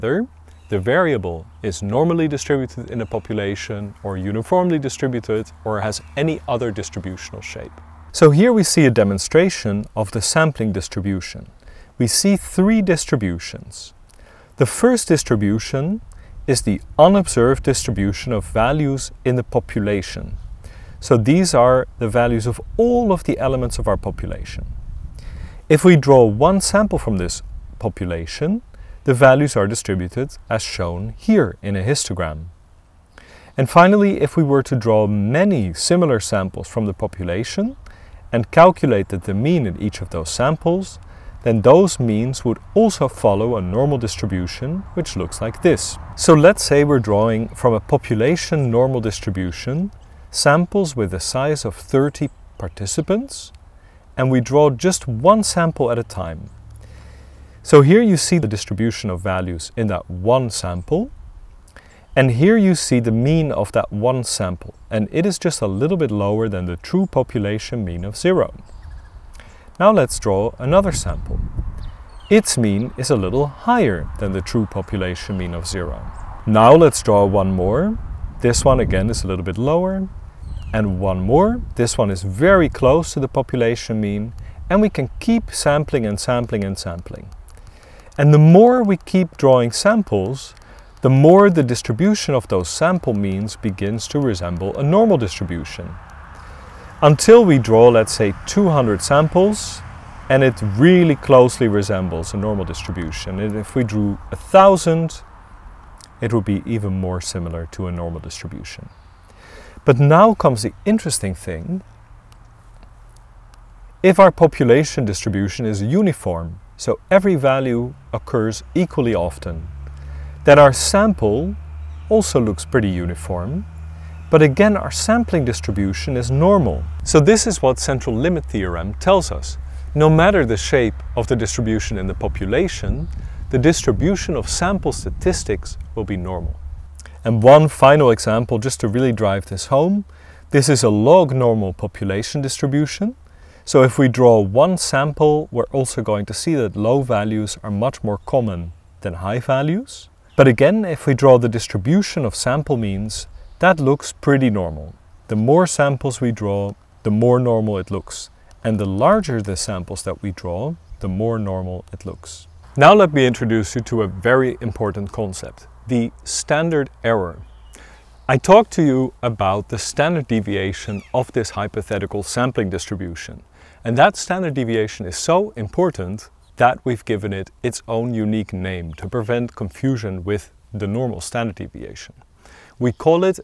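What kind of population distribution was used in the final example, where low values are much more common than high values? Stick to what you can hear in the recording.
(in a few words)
log normal.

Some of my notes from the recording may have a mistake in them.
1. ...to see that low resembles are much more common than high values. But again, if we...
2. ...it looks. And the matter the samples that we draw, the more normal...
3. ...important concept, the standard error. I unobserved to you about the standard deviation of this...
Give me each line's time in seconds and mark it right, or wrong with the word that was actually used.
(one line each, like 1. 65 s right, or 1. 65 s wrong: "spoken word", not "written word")
1. 146 s wrong: "values", not "resembles"
2. 157 s wrong: "larger", not "matter"
3. 164 s wrong: "talked", not "unobserved".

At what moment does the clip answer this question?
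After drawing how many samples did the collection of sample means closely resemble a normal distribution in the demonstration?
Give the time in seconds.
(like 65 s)
98 s.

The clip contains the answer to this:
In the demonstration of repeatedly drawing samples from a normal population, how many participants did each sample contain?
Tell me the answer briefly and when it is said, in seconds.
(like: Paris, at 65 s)
30, at 51 s.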